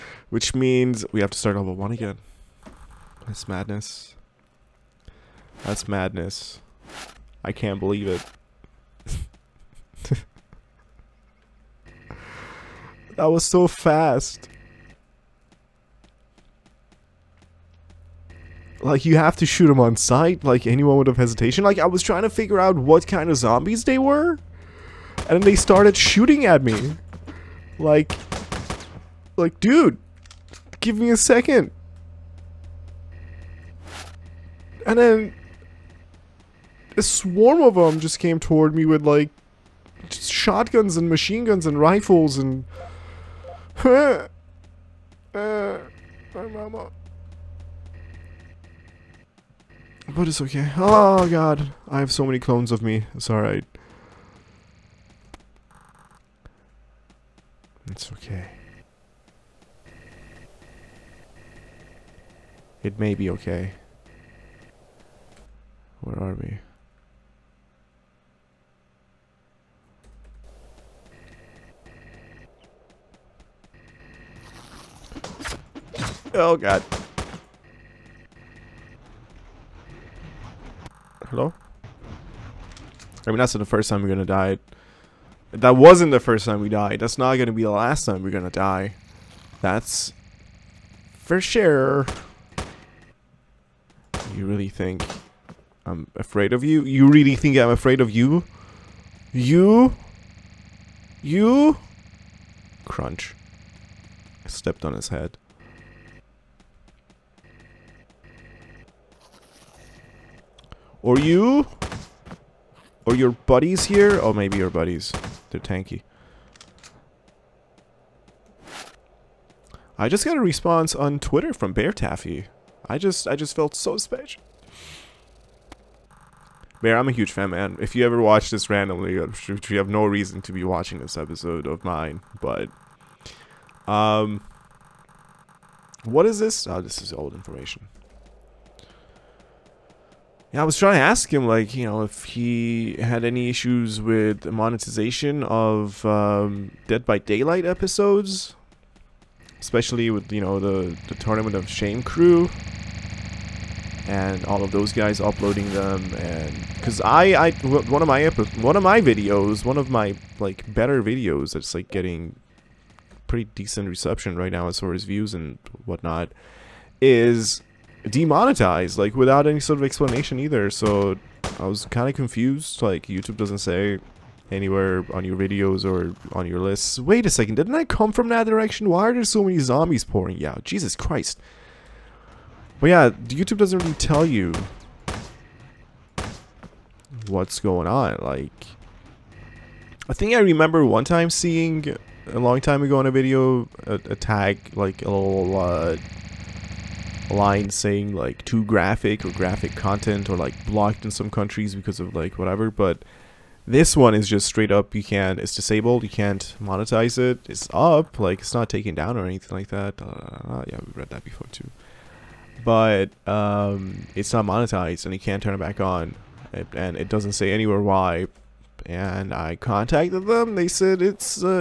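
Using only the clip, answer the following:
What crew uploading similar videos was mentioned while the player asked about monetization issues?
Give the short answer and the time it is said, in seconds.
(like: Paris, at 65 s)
Tournament of Shame, at 151 s.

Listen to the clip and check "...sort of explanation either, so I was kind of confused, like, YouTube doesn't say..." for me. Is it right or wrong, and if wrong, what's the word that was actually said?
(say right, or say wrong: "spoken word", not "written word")
right.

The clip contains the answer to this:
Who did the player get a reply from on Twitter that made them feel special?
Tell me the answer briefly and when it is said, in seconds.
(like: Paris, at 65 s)
Bear Taffy, at 121 s.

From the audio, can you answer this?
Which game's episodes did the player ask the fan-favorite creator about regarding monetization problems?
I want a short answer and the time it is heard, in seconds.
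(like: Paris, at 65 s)
Dead by Daylight, at 146 s.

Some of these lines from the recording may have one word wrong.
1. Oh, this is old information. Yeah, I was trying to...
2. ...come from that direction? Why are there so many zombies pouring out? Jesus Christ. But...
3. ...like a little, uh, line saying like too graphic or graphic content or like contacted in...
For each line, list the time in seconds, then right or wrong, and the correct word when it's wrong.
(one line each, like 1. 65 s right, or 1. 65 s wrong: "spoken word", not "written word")
1. 136 s right
2. 177 s right
3. 194 s wrong: "blocked", not "contacted".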